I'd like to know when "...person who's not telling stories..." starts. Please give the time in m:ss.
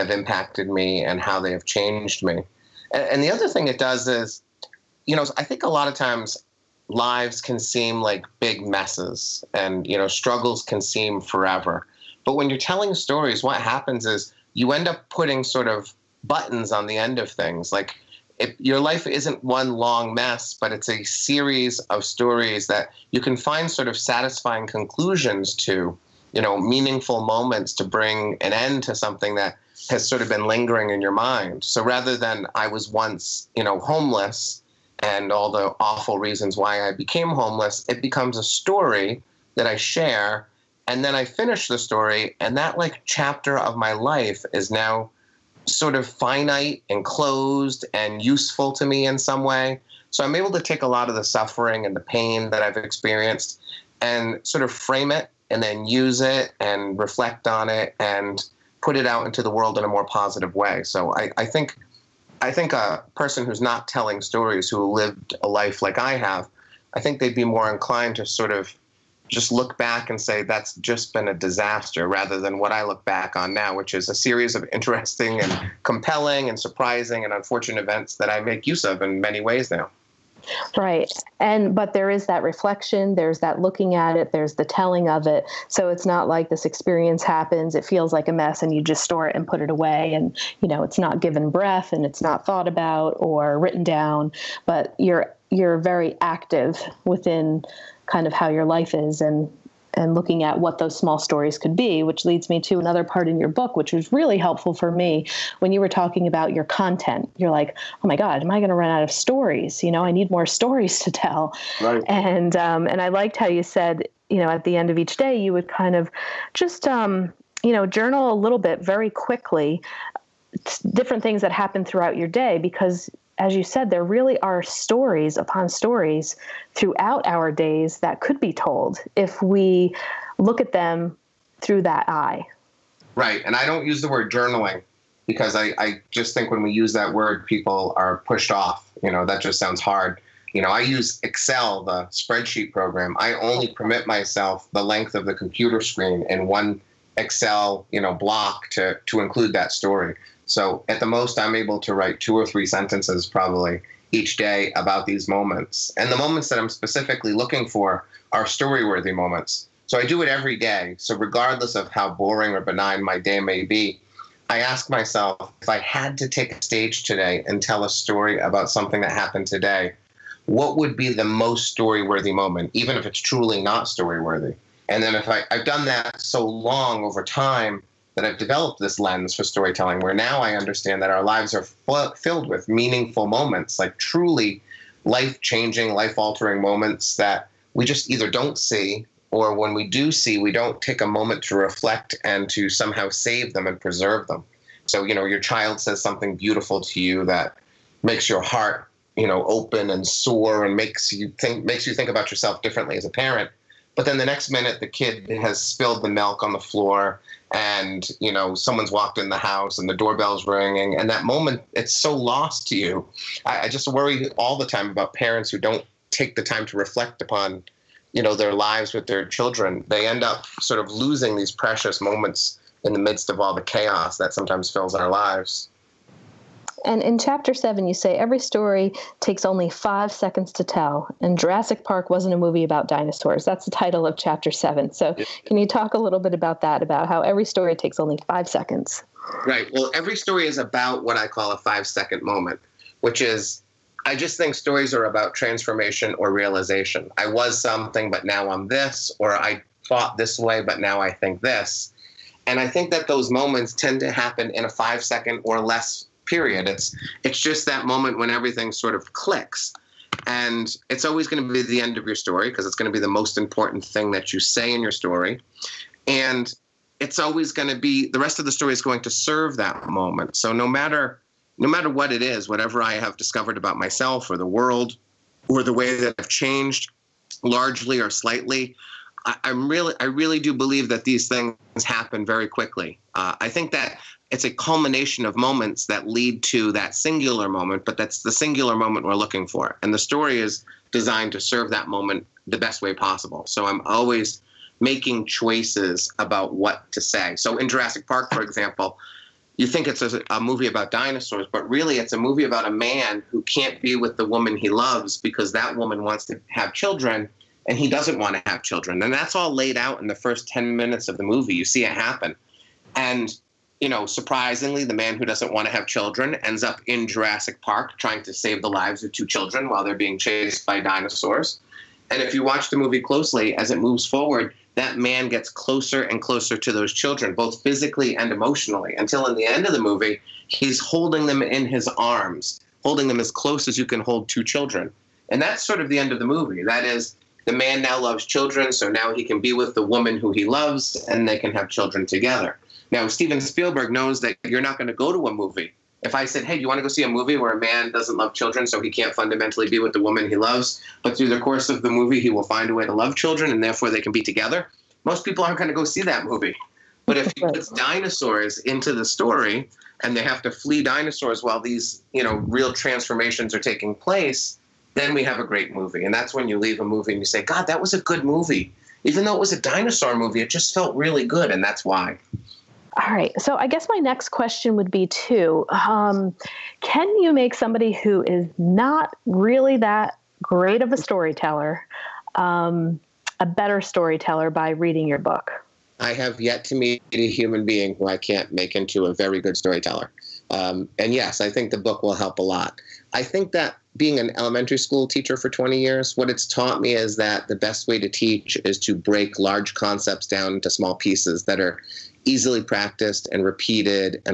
1:03.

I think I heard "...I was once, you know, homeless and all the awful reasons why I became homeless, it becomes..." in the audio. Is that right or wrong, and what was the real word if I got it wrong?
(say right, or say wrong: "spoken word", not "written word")
right.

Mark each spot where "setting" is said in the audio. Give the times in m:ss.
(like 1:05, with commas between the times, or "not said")
not said.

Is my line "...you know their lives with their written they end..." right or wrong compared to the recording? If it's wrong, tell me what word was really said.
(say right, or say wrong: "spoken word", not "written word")
wrong: "children", not "written".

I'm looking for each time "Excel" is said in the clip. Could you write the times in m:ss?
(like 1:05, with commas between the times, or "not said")
2:21, 2:27.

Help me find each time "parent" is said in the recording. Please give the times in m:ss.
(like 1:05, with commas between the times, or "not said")
3:23, 3:35.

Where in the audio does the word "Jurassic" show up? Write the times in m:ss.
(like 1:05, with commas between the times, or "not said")
3:51, 4:57, 5:17.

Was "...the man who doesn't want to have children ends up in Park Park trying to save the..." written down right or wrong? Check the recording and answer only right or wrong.
wrong.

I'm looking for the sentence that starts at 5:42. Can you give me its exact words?
Now, Steven Spielberg knows that you're not going to go to a movie.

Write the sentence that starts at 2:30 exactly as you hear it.
So at the most, I'm able to write two or three sentences probably each day about these moments.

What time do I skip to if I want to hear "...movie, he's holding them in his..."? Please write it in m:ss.
5:29.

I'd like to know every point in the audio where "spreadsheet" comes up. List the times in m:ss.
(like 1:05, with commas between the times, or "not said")
2:22.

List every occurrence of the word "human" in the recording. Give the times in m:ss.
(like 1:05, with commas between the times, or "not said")
6:27.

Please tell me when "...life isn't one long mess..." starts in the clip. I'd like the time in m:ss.
0:18.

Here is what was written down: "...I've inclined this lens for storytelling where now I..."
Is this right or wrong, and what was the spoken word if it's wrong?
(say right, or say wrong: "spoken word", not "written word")
wrong: "developed", not "inclined".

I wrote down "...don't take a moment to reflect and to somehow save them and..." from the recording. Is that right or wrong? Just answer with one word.
right.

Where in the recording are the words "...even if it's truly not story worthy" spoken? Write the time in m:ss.
2:52.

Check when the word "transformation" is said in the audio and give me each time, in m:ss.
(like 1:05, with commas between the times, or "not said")
4:05, 6:02.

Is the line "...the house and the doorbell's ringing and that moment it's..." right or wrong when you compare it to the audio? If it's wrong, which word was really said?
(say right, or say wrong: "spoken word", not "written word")
right.